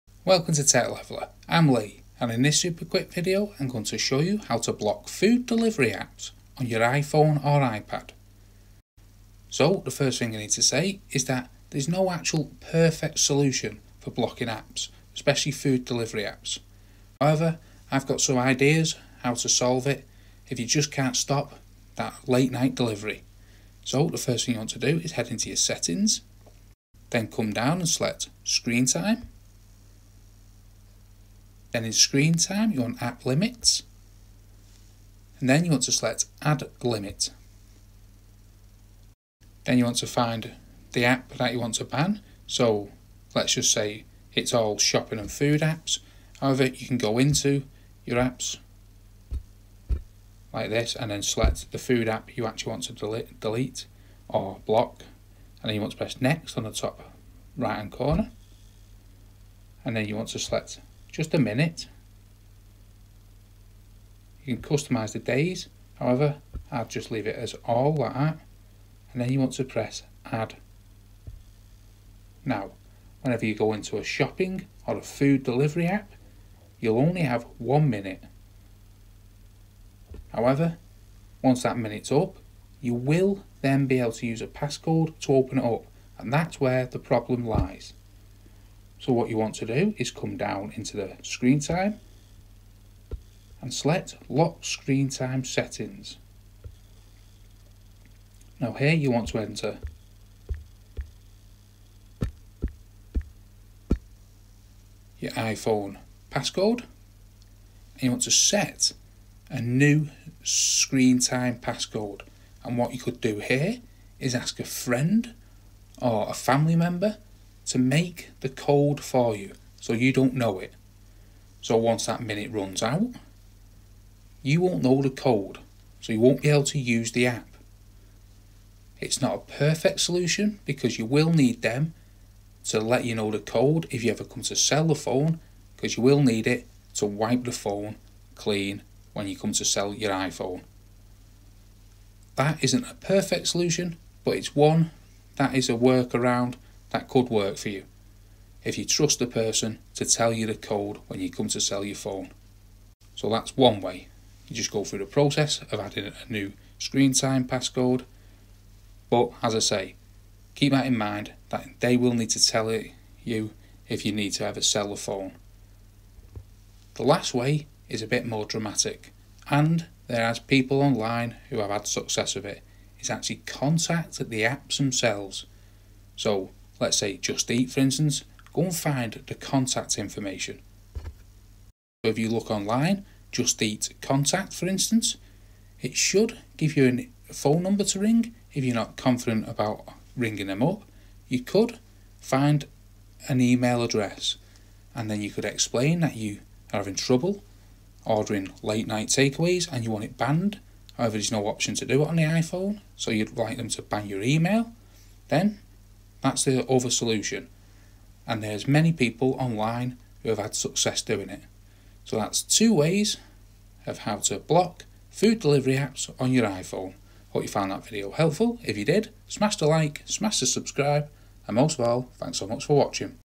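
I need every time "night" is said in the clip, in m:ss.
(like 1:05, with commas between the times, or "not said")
0:22, 3:18.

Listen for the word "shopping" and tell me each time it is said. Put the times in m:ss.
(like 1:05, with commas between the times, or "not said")
0:44, 1:14.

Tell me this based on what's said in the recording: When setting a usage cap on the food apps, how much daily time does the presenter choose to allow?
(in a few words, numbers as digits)
1 minute.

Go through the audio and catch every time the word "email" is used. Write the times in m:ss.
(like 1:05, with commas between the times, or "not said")
3:13, 3:24.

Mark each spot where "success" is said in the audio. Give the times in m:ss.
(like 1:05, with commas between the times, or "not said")
2:51, 3:30.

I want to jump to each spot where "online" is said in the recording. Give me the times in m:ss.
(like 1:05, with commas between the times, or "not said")
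2:50, 3:02, 3:29.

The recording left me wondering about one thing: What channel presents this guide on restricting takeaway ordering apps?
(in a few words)
Tech Leveller.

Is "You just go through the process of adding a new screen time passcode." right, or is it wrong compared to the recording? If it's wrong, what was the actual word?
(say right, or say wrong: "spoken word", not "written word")
right.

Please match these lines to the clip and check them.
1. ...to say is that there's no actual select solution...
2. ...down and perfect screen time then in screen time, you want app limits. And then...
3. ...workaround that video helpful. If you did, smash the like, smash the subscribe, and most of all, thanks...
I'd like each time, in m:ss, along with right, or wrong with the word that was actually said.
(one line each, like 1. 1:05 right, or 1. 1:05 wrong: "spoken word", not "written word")
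1. 0:10 wrong: "perfect", not "select"
2. 0:27 wrong: "select", not "perfect"
3. 3:37 wrong: "found", not "workaround".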